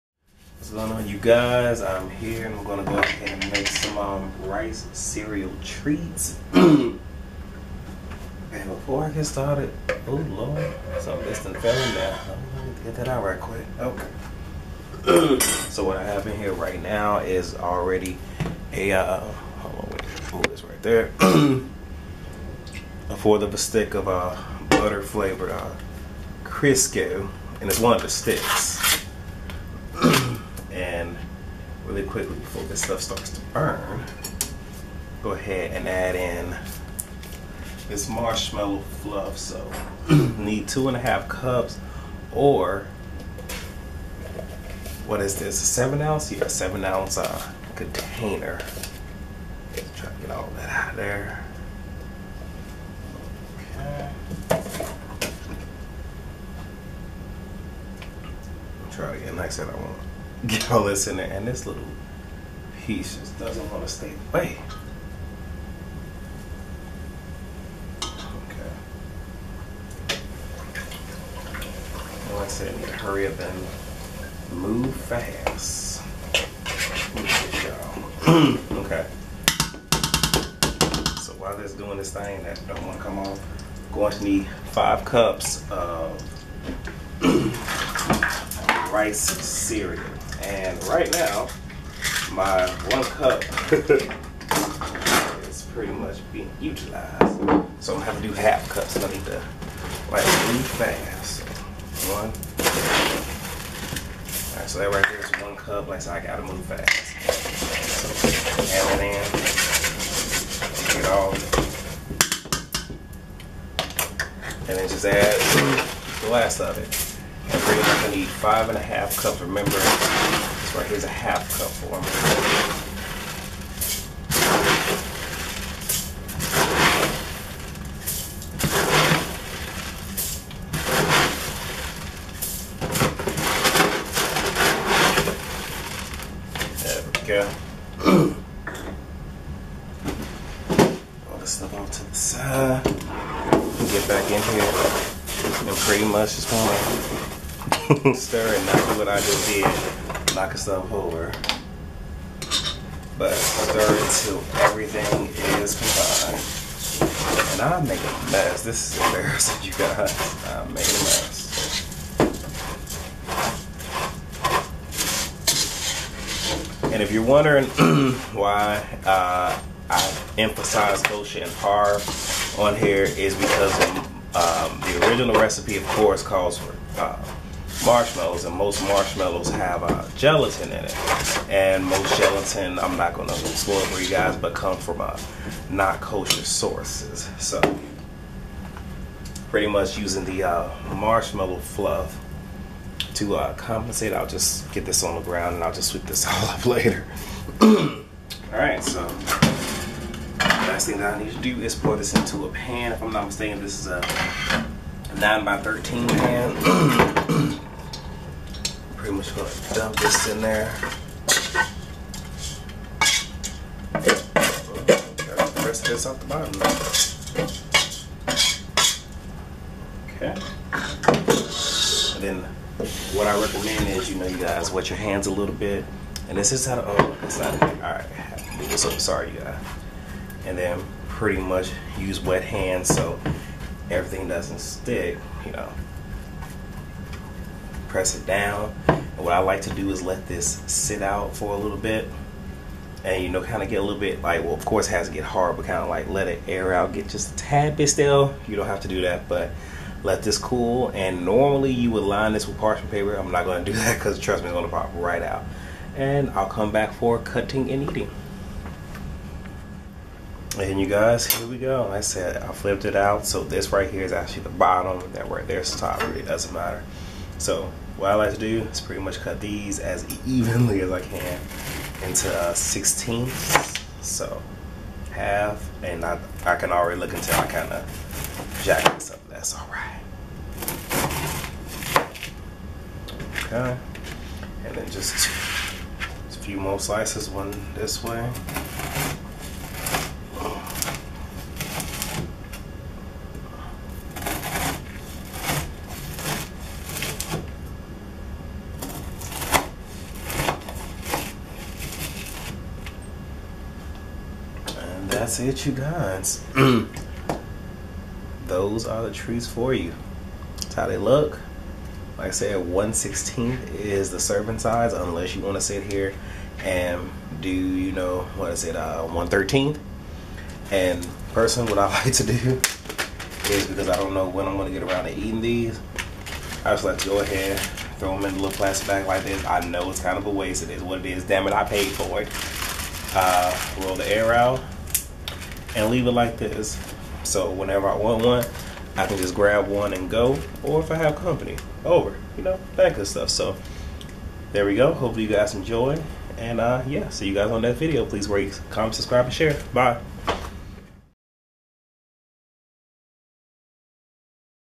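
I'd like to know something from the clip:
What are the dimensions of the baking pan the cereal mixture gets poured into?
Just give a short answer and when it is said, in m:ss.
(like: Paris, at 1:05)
9 by 13, at 3:25.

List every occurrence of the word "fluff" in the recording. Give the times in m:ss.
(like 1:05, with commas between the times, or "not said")
0:39, 3:11.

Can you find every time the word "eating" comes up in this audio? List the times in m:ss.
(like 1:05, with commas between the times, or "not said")
4:17, 5:25.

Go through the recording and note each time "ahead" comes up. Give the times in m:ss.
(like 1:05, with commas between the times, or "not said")
0:02, 0:35, 5:27.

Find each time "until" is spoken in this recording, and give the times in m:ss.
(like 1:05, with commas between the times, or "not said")
2:34, 4:37.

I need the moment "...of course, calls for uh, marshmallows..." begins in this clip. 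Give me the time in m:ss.
2:55.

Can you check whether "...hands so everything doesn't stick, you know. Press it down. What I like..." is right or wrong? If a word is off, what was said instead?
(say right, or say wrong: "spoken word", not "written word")
right.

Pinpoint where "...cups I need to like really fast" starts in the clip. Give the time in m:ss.
1:38.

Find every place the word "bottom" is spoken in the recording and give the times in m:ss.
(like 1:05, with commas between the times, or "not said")
3:36, 4:24.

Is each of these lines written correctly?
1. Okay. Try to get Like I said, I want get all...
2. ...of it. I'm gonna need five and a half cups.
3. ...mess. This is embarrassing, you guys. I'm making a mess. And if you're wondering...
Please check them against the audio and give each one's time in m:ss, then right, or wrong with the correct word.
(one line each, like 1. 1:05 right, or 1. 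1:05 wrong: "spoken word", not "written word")
1. 0:53 right
2. 1:56 right
3. 2:38 right.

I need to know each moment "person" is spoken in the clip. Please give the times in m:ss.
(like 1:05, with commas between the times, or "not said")
5:21.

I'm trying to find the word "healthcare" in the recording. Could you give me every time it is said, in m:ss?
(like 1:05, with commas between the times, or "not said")
not said.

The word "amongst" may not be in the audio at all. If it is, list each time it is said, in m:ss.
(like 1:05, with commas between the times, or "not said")
not said.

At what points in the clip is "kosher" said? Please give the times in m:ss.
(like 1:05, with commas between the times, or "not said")
2:51, 3:06.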